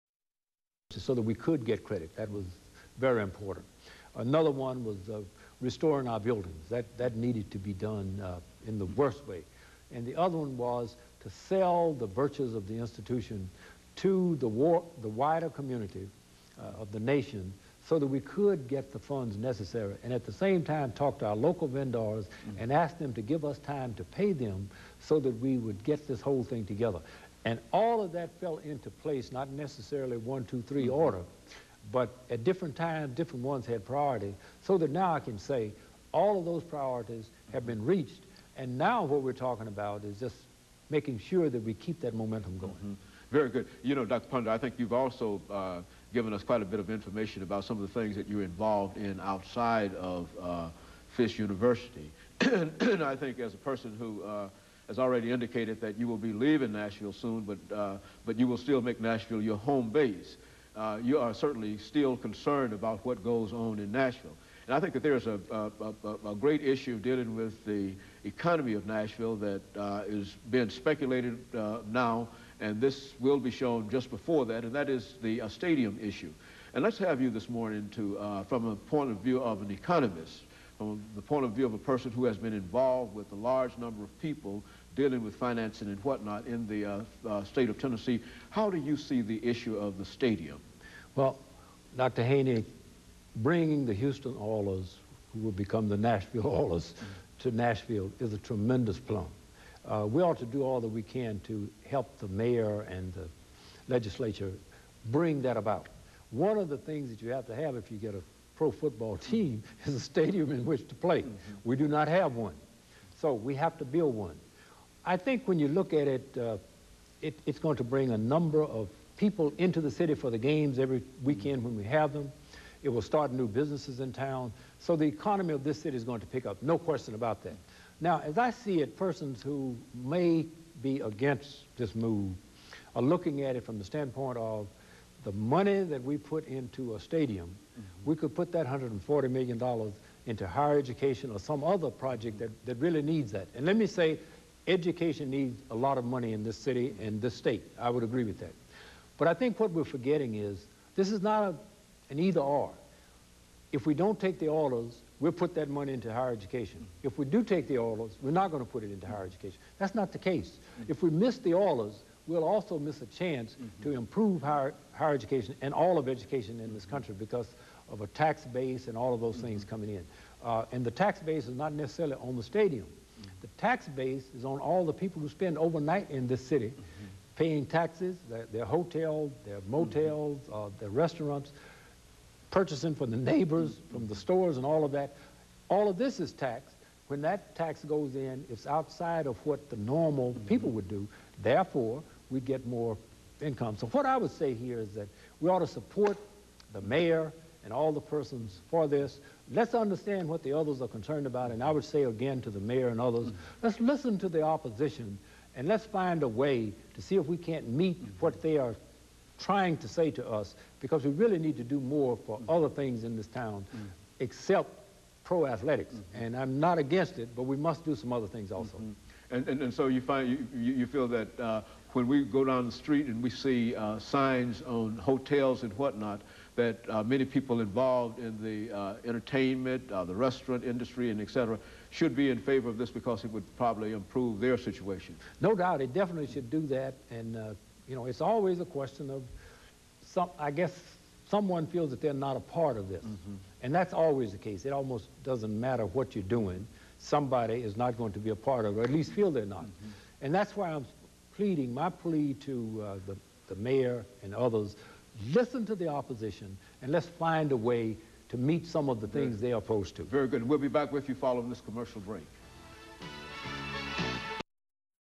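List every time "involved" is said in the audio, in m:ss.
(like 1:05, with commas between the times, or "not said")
0:48, 1:22, 3:47.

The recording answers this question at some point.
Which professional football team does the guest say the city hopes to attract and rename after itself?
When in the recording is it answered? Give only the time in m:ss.
1:33.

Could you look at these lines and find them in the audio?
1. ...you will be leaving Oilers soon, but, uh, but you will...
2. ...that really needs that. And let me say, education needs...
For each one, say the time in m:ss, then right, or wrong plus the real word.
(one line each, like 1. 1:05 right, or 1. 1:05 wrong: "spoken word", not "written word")
1. 0:55 wrong: "Nashville", not "Oilers"
2. 2:22 right.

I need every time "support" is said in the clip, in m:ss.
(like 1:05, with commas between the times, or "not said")
3:15.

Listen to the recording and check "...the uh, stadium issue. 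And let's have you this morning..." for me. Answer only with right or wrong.
right.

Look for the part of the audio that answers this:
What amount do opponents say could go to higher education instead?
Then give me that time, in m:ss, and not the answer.
2:18.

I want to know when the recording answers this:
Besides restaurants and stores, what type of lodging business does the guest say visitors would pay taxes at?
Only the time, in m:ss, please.
2:59.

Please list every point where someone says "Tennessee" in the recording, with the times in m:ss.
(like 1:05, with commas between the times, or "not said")
1:27.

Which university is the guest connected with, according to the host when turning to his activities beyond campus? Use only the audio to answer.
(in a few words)
Fish University.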